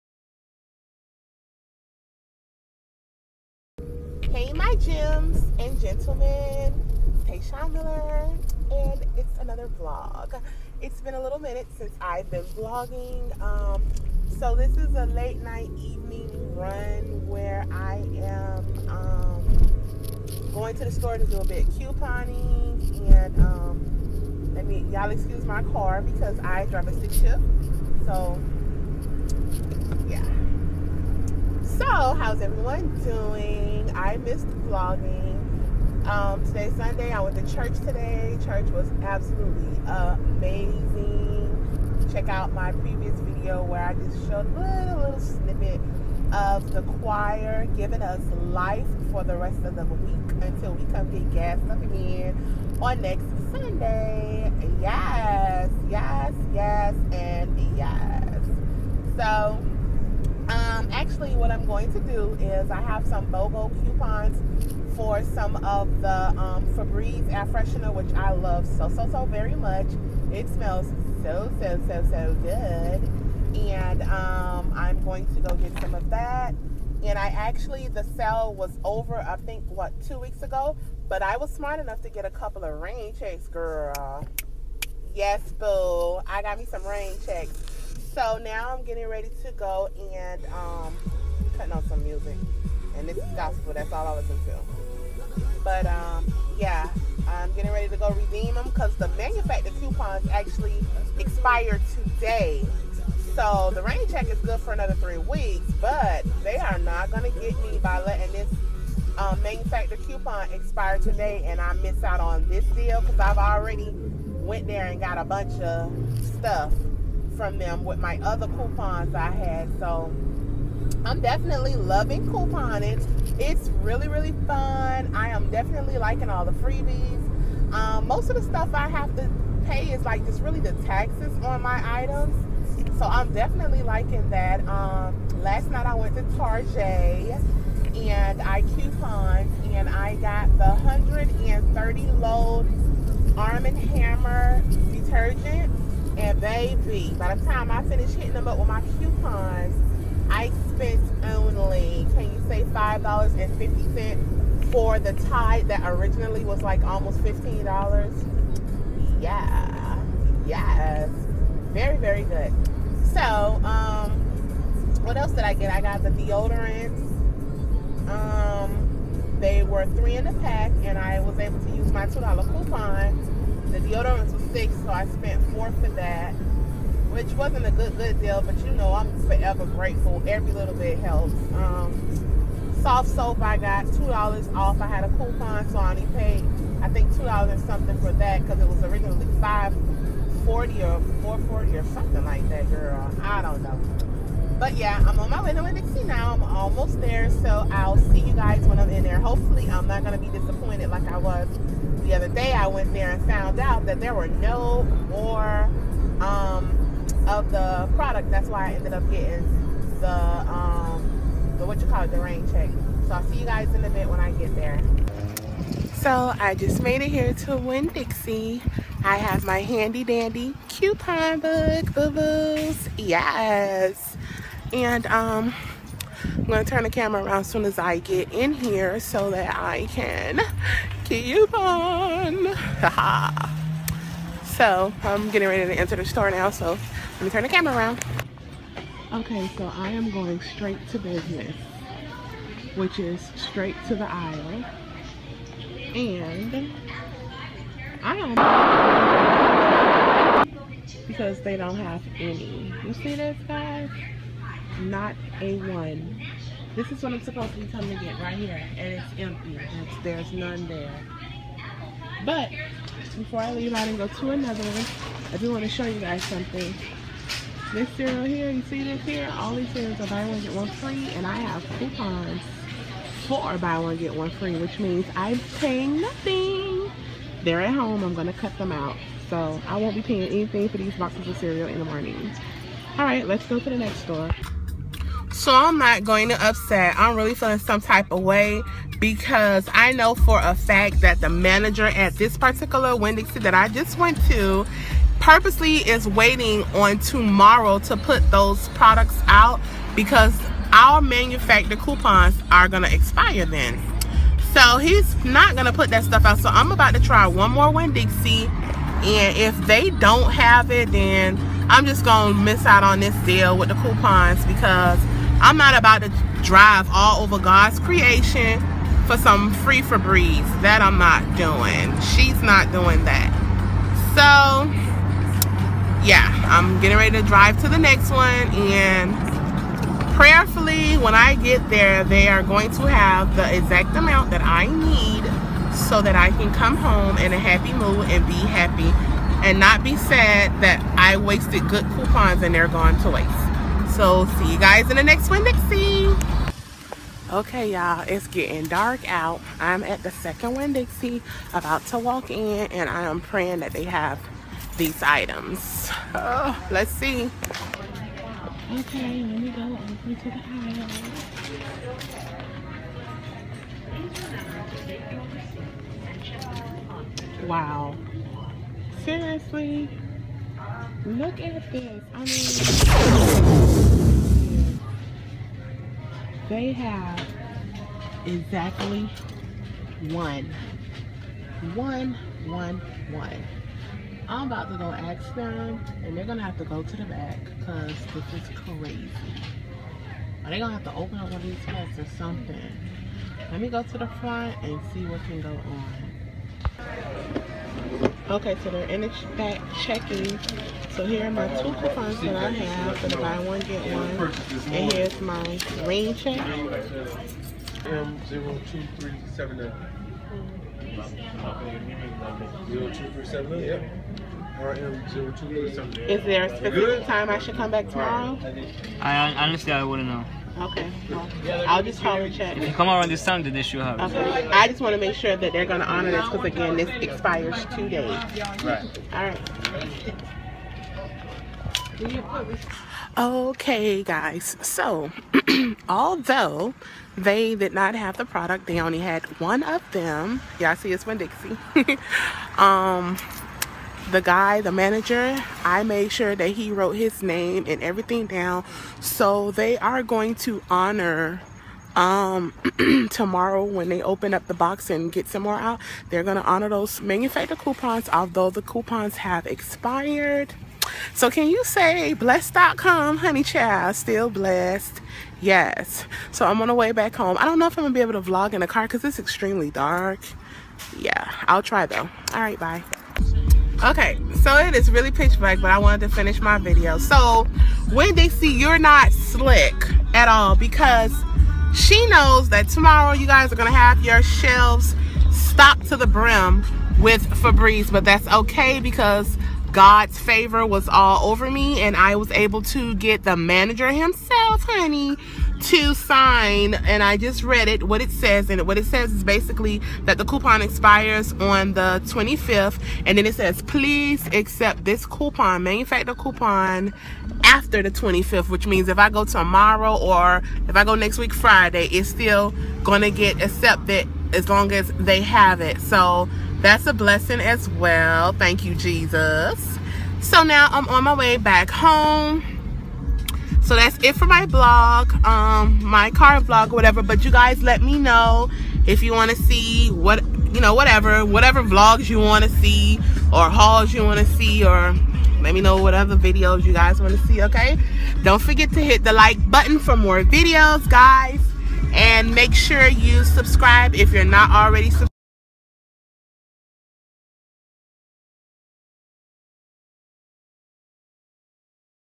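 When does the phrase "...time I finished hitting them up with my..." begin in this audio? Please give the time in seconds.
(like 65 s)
147 s.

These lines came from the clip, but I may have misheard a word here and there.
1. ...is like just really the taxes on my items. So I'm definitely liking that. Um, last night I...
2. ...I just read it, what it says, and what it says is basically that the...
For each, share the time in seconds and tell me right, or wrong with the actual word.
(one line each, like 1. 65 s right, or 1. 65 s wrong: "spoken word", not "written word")
1. 129 s right
2. 497 s right.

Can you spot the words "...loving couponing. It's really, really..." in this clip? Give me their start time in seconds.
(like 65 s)
121 s.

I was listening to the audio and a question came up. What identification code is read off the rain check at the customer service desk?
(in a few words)
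M02379.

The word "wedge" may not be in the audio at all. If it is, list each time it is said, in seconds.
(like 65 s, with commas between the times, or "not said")
not said.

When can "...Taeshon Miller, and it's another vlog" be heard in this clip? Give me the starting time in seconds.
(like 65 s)
7 s.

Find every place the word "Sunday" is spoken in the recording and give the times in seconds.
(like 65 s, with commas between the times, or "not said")
36 s, 53 s.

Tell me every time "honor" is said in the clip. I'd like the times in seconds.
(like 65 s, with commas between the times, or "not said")
425 s, 450 s, 456 s.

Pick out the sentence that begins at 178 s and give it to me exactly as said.
But you know, I'm forever grateful.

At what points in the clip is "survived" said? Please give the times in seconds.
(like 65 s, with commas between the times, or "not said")
not said.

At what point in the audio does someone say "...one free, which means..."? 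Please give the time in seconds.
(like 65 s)
274 s.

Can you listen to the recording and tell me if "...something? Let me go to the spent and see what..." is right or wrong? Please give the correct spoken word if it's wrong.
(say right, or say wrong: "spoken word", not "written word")
wrong: "front", not "spent".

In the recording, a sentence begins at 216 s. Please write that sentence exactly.
So I just made it here to Winn-Dixie I have my handy dandy coupon book, boo-boos.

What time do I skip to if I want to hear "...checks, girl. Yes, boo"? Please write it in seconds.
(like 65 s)
83 s.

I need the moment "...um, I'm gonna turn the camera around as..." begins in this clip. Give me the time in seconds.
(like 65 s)
225 s.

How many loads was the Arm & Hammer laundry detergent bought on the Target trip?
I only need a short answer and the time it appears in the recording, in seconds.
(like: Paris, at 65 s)
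130, at 140 s.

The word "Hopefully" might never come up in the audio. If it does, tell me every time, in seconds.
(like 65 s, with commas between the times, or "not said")
199 s.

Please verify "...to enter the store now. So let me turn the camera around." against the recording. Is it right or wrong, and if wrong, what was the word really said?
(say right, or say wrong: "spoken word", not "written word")
right.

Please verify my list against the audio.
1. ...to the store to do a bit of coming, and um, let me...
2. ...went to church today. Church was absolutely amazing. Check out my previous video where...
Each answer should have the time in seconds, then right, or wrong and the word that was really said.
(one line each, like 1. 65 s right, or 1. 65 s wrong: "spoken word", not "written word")
1. 20 s wrong: "couponing", not "coming"
2. 37 s right.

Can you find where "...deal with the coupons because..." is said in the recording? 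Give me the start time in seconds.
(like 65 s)
313 s.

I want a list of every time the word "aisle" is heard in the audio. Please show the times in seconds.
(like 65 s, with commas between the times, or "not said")
244 s, 360 s.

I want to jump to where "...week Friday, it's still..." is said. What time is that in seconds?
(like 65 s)
511 s.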